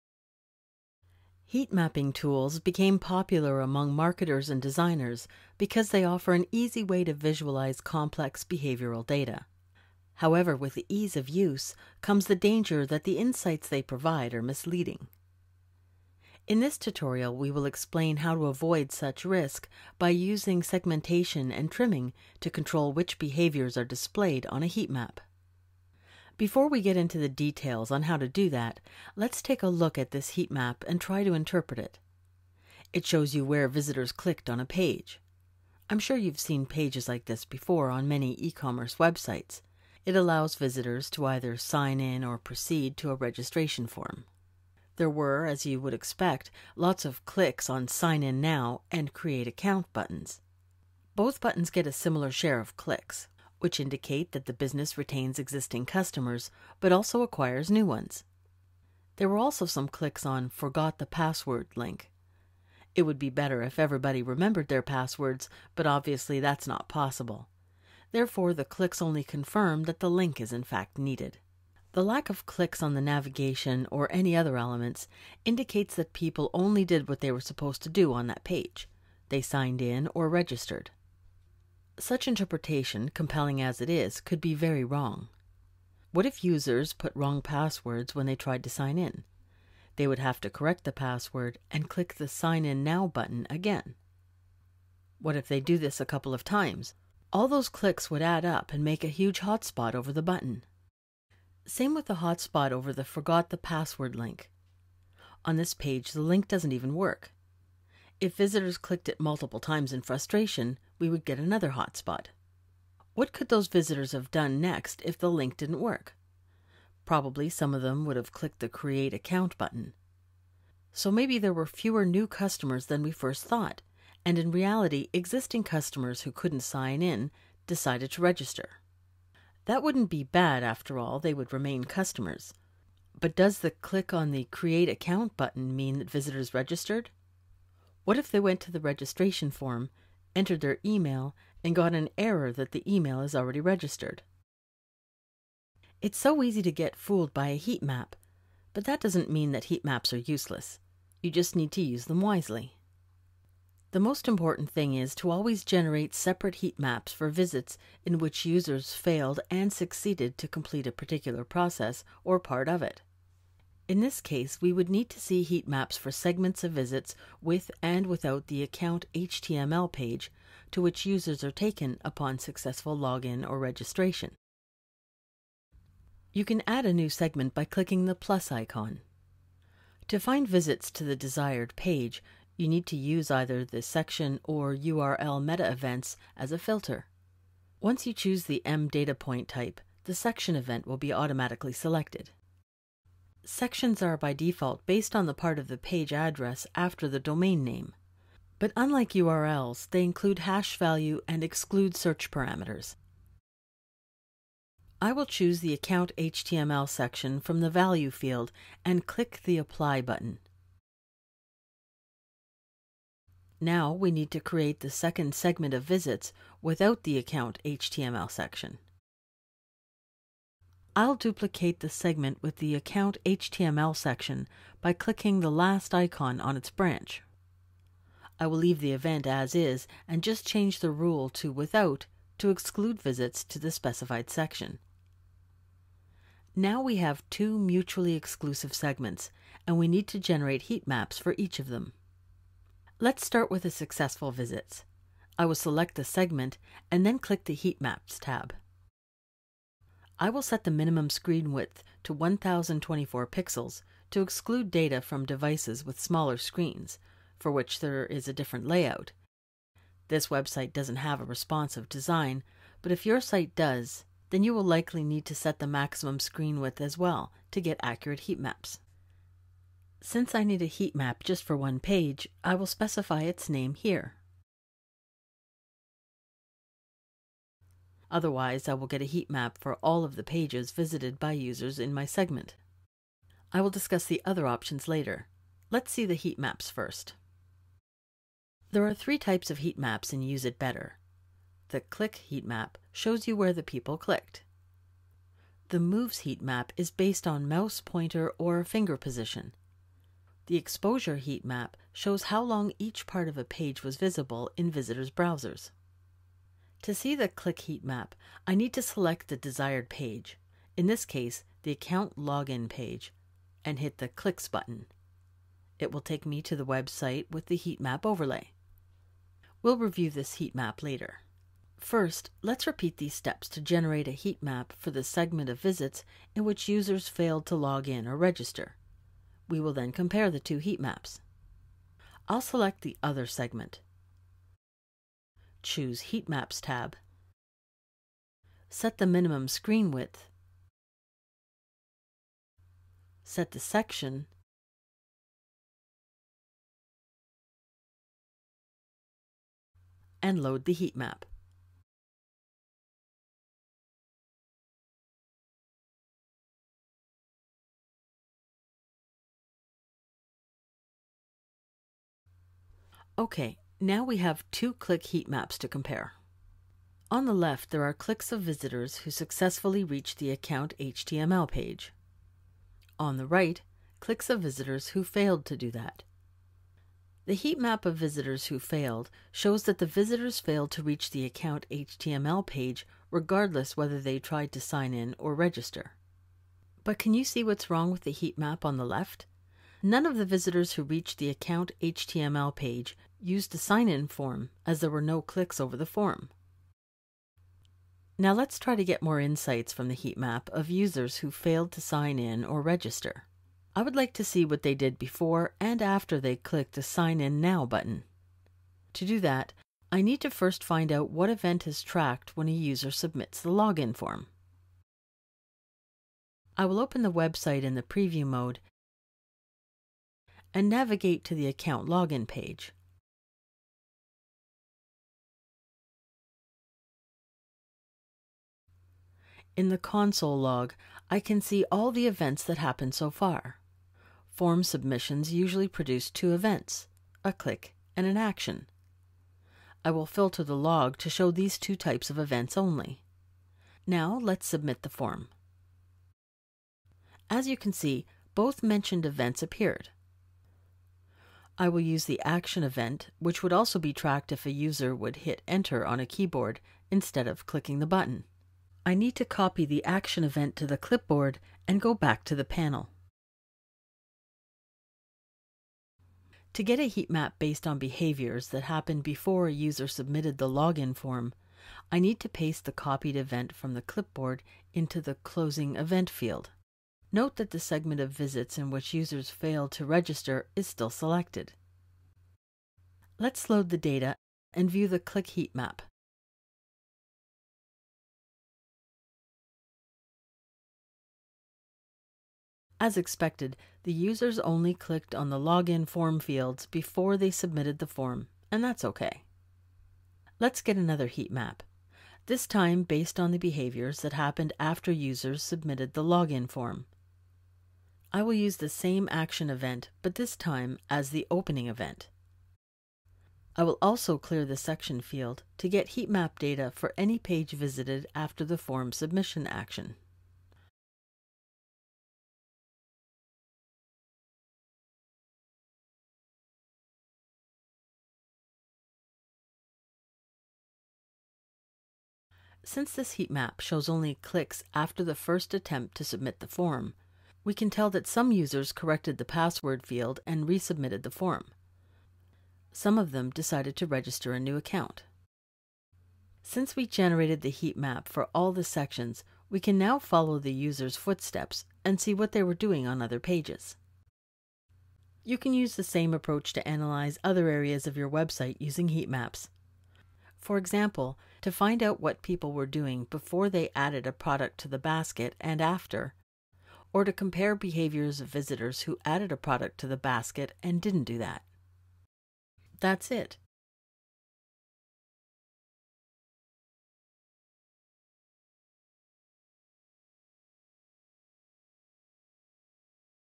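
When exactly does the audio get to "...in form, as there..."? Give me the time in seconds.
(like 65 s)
393 s.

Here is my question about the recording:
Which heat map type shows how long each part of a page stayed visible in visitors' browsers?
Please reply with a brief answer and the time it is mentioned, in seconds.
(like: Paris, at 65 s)
Exposure, at 300 s.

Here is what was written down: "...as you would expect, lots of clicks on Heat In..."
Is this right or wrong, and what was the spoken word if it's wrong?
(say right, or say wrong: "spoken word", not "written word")
wrong: "Sign", not "Heat".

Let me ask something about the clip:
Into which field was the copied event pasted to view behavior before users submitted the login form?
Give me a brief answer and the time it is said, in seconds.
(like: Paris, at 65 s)
closing event, at 475 s.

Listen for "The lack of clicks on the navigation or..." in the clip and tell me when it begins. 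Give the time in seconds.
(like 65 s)
71 s.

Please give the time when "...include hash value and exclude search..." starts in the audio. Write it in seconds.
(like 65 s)
200 s.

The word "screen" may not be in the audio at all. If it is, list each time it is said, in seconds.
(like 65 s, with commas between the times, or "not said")
251 s, 256 s, 266 s, 339 s.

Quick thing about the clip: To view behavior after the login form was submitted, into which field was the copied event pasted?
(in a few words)
opening event.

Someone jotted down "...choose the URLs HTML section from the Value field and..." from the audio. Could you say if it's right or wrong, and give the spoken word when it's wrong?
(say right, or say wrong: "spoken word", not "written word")
wrong: "Account", not "URLs".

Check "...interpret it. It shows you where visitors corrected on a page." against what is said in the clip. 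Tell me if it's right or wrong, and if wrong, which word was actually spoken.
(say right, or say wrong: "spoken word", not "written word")
wrong: "clicked", not "corrected".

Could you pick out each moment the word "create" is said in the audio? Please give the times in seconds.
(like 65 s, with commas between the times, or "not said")
49 s, 118 s, 134 s, 214 s.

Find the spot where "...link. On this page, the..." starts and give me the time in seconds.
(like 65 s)
104 s.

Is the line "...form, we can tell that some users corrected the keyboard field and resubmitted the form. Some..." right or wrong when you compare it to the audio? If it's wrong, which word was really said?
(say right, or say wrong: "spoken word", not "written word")
wrong: "password", not "keyboard".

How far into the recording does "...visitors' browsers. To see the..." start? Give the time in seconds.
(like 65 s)
304 s.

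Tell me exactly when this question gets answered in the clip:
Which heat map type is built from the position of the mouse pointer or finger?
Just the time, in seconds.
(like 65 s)
295 s.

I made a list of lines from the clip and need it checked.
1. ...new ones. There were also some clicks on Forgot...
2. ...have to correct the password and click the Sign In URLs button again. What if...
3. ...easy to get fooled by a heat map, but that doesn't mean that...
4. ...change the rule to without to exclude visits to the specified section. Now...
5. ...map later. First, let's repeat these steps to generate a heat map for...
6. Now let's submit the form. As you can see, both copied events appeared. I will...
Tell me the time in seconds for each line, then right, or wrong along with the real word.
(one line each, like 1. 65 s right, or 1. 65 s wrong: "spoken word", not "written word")
1. 57 s right
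2. 90 s wrong: "Now", not "URLs"
3. 146 s right
4. 230 s right
5. 320 s right
6. 443 s wrong: "mentioned", not "copied".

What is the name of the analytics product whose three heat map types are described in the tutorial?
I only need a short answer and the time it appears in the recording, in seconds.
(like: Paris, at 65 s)
UseItBetter, at 290 s.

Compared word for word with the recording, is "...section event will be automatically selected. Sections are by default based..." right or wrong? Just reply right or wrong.
right.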